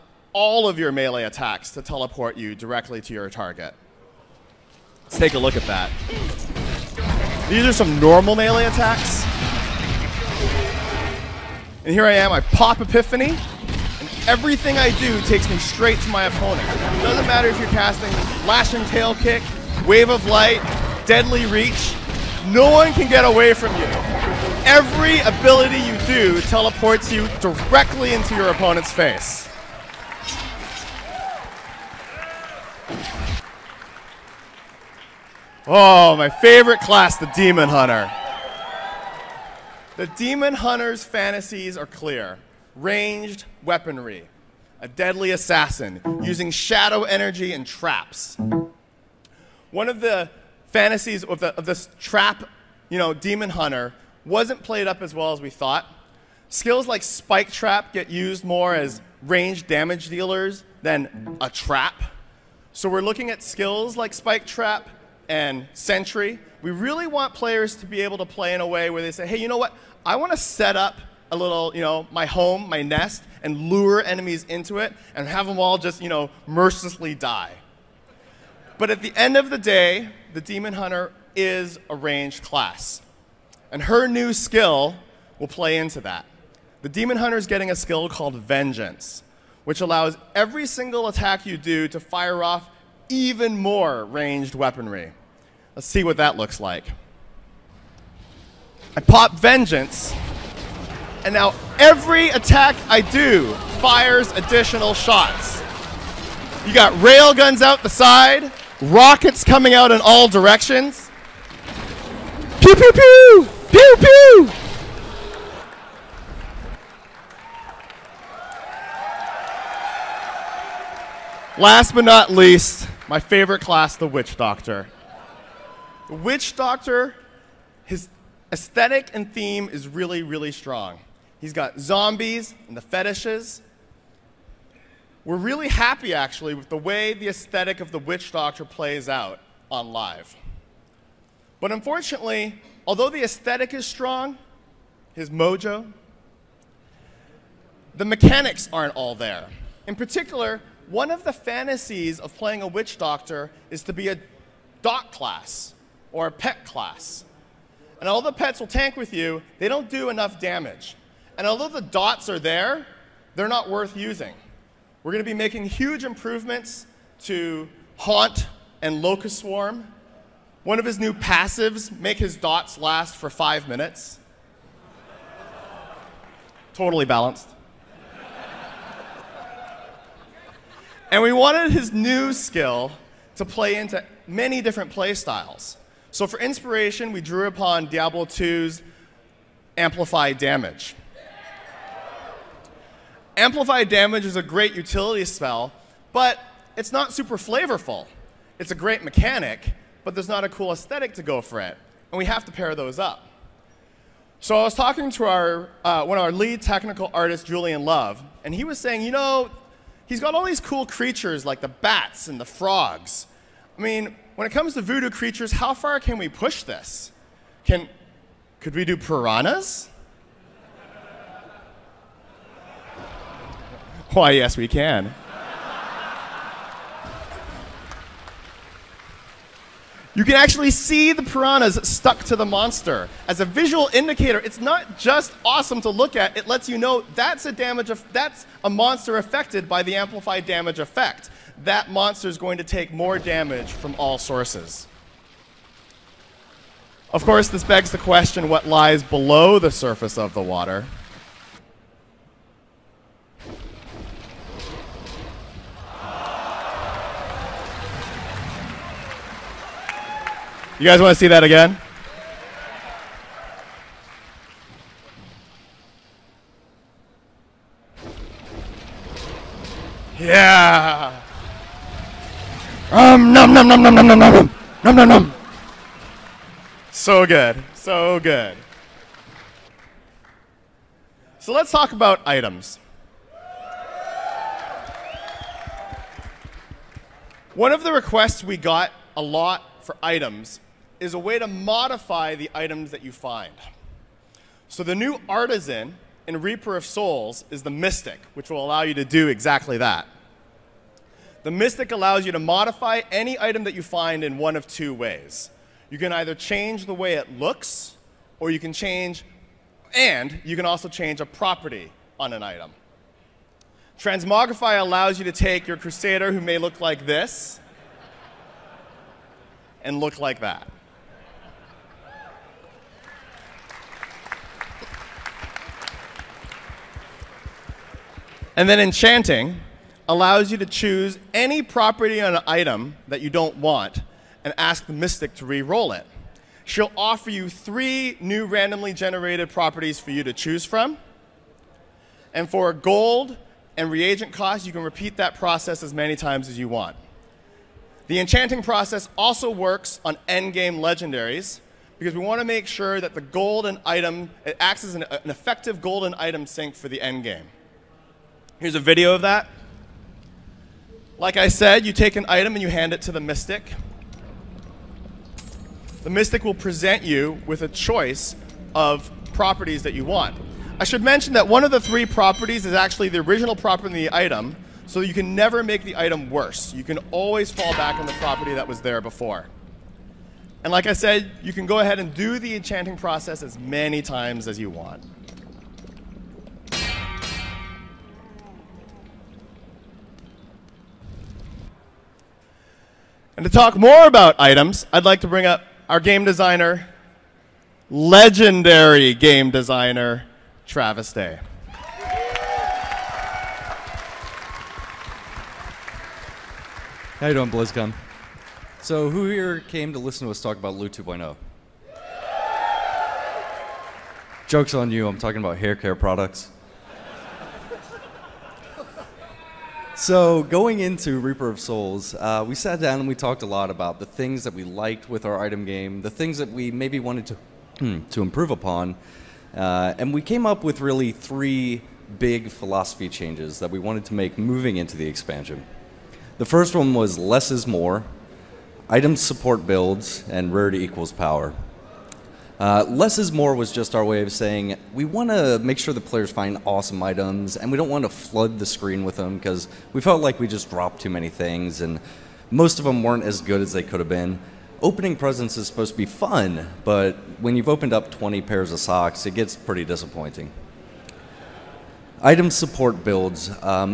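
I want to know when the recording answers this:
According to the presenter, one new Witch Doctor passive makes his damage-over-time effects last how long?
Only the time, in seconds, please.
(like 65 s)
173 s.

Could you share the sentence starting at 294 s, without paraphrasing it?
So the new artisan in Reaper of Souls is the mystic, which will allow you to do exactly that.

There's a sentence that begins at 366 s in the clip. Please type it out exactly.
The mystic will present you with a choice of properties that you want.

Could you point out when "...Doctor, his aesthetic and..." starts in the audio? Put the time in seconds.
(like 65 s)
126 s.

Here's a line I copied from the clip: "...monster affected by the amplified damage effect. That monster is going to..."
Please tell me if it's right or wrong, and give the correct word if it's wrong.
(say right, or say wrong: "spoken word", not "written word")
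right.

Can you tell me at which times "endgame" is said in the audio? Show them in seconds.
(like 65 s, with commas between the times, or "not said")
350 s, 356 s.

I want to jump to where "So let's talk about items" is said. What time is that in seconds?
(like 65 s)
281 s.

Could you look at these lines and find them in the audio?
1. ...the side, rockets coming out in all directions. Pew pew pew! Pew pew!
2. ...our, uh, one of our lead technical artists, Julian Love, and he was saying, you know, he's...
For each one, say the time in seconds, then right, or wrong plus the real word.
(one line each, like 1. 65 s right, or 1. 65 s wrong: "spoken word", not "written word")
1. 107 s right
2. 205 s right.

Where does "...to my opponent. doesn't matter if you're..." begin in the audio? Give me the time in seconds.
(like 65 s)
16 s.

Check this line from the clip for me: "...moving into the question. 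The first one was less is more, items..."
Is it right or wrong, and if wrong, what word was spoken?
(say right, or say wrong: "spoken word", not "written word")
wrong: "expansion", not "question".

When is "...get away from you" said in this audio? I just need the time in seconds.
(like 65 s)
23 s.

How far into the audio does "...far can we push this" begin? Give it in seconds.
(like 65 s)
215 s.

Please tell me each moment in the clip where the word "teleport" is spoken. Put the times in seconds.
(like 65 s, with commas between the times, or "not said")
1 s, 26 s.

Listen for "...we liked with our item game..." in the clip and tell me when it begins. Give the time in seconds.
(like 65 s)
424 s.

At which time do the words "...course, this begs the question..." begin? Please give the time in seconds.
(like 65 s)
247 s.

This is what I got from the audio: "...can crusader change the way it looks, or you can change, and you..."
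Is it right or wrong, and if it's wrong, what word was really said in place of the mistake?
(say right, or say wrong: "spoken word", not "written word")
wrong: "either", not "crusader".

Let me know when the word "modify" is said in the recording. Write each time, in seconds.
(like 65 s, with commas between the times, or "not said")
291 s, 302 s.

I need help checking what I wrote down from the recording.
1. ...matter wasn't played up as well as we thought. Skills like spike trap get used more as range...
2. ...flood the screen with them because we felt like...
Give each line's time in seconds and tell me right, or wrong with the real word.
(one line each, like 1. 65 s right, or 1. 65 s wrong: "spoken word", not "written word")
1. 53 s wrong: "hunter", not "matter"
2. 448 s right.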